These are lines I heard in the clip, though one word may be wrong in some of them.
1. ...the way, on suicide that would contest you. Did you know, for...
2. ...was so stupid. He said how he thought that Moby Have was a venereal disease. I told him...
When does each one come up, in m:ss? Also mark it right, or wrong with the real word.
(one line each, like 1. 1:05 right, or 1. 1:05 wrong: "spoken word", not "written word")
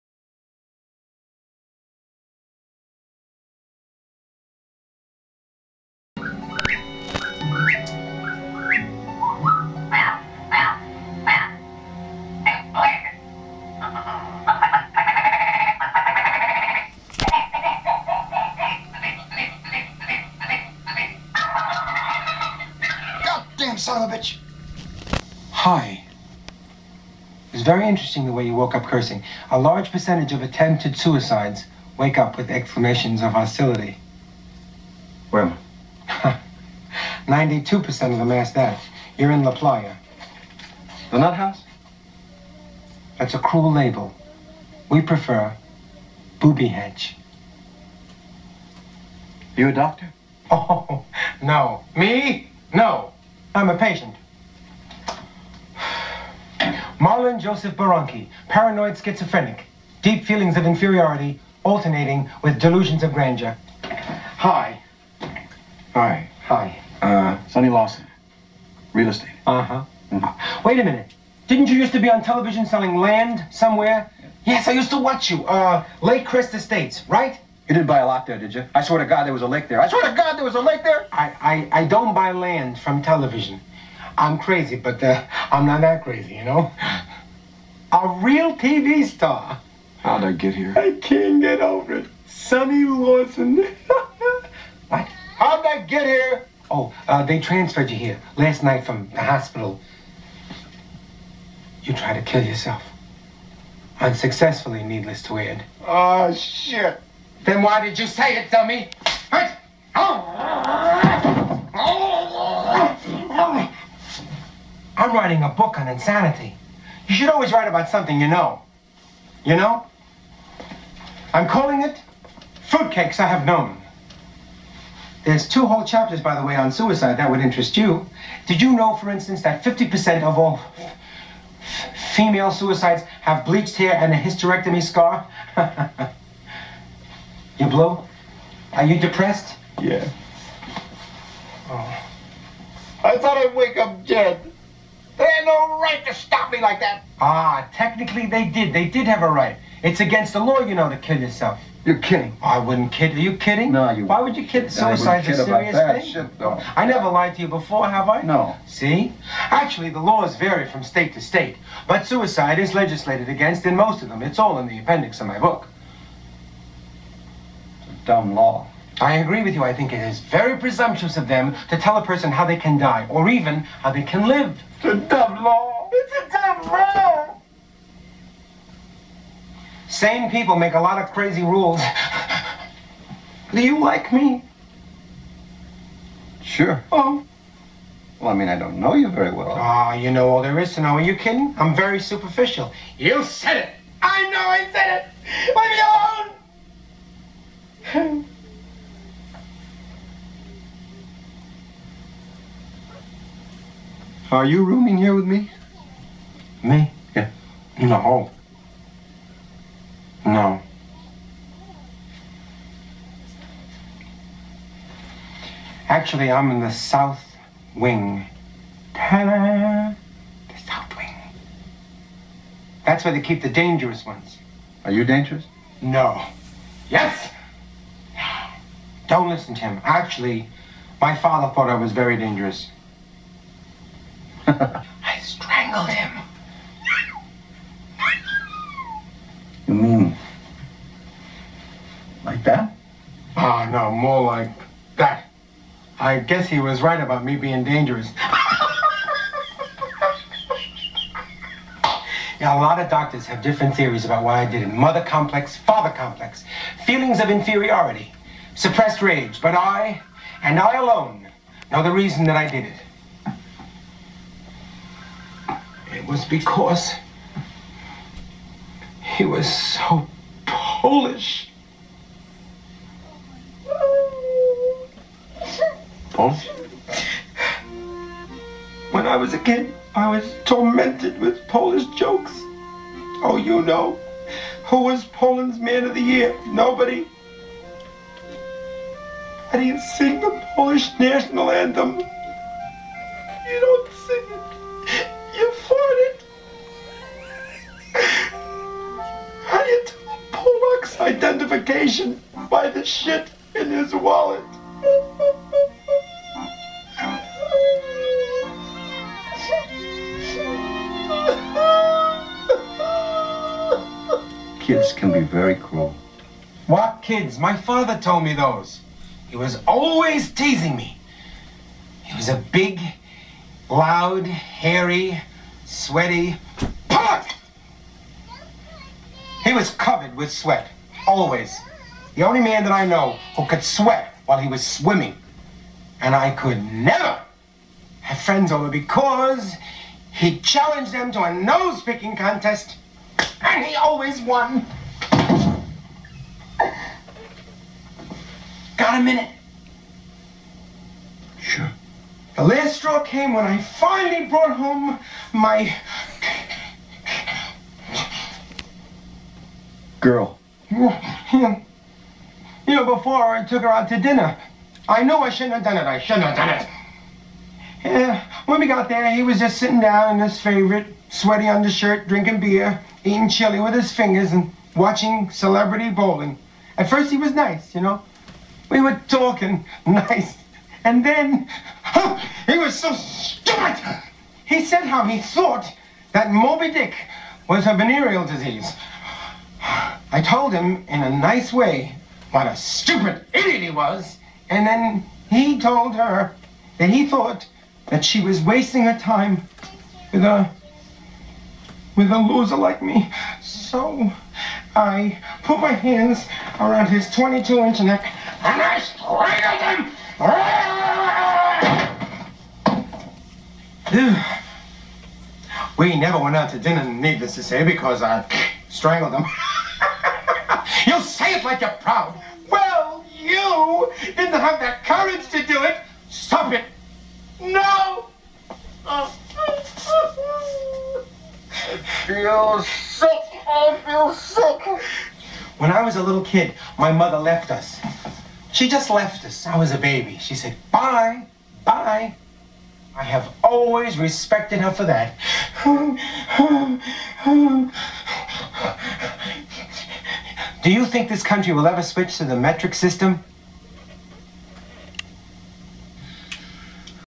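1. 2:06 wrong: "interest", not "contest"
2. 6:22 wrong: "Dick", not "Have".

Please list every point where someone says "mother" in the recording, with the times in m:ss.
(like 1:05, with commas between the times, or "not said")
4:14, 7:16.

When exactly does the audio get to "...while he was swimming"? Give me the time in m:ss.
5:34.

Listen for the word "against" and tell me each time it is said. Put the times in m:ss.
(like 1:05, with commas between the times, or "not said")
2:29, 2:43.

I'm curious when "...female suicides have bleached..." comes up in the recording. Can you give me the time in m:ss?
2:12.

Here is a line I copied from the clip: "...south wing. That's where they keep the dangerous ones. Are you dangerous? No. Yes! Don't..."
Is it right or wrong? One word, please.
right.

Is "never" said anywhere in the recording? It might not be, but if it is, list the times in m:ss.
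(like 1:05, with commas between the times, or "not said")
2:36, 5:36, 6:55.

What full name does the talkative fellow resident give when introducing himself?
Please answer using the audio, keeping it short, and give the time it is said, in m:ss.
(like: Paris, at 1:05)
Marlon Joseph Borunki, at 0:56.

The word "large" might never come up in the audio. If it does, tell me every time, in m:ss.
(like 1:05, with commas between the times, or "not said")
0:29.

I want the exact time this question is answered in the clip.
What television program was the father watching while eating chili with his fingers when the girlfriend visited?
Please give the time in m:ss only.
6:15.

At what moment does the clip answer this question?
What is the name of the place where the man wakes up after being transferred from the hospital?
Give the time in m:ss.
0:39.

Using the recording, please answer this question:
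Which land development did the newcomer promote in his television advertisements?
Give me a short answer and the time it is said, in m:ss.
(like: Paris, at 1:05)
Lake Crest Estates, at 1:16.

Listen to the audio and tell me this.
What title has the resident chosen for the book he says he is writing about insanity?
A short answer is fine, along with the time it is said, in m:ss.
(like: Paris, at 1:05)
Fruitcakes I Have Known, at 2:02.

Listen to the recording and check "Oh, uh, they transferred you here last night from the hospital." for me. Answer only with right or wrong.
right.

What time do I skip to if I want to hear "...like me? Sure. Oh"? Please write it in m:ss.
3:03.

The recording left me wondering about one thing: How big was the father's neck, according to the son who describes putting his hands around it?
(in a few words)
22 inches.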